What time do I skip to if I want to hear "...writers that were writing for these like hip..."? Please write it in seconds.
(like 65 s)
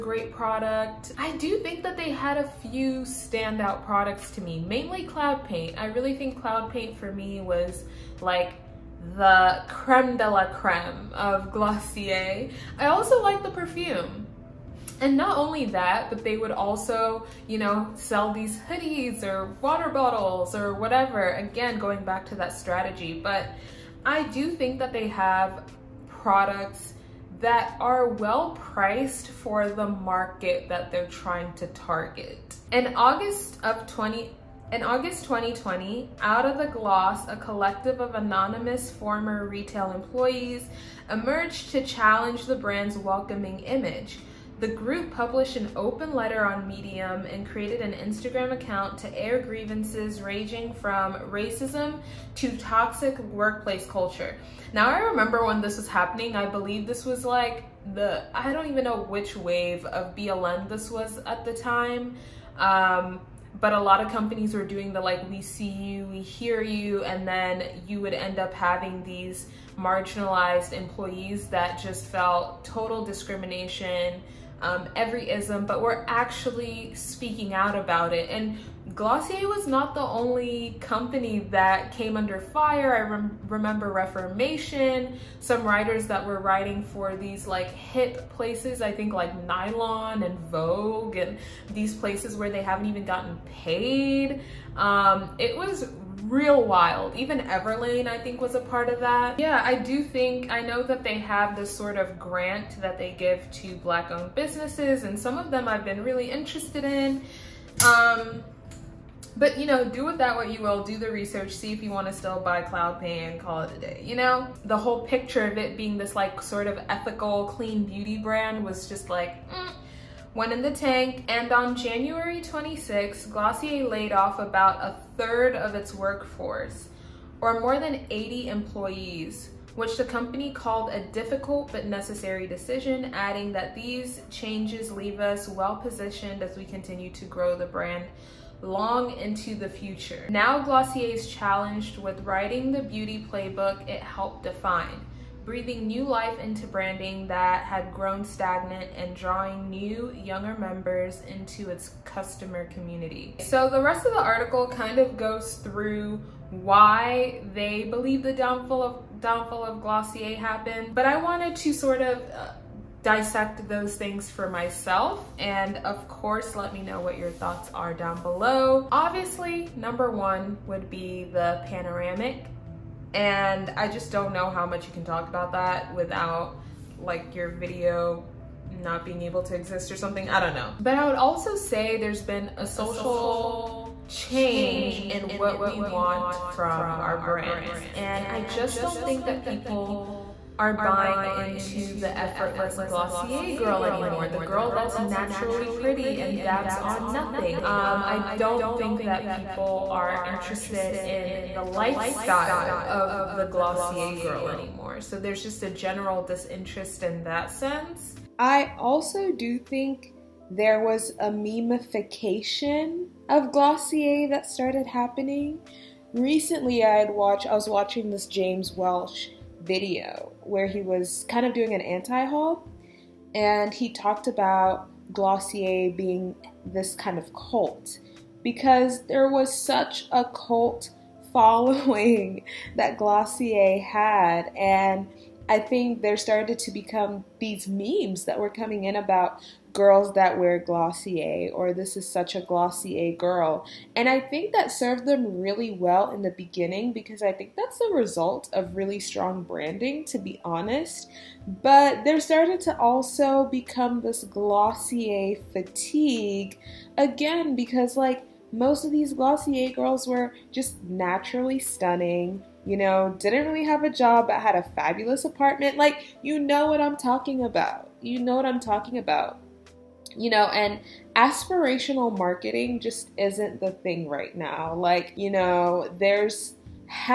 85 s.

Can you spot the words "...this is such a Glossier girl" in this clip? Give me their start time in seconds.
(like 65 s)
241 s.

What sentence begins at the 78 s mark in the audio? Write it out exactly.
And Glossier was not the only company that came under fire.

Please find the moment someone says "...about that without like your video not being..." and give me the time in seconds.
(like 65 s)
175 s.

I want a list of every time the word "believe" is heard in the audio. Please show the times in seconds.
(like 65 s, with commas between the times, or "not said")
56 s, 157 s.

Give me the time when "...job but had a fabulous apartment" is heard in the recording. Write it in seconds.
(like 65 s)
263 s.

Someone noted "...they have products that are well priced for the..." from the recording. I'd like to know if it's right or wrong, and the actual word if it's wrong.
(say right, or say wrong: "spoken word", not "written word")
right.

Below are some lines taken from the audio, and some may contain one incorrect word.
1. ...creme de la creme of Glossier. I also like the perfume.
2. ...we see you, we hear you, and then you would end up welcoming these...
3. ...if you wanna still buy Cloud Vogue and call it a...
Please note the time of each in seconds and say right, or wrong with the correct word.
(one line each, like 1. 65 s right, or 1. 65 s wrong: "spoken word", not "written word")
1. 9 s right
2. 65 s wrong: "having", not "welcoming"
3. 111 s wrong: "Pay", not "Vogue".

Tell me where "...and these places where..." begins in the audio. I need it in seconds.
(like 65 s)
91 s.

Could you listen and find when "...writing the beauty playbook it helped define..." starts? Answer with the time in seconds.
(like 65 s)
142 s.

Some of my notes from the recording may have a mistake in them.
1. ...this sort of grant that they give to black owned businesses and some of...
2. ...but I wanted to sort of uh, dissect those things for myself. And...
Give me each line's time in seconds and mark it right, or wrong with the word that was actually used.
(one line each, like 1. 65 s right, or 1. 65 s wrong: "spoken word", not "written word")
1. 101 s right
2. 160 s right.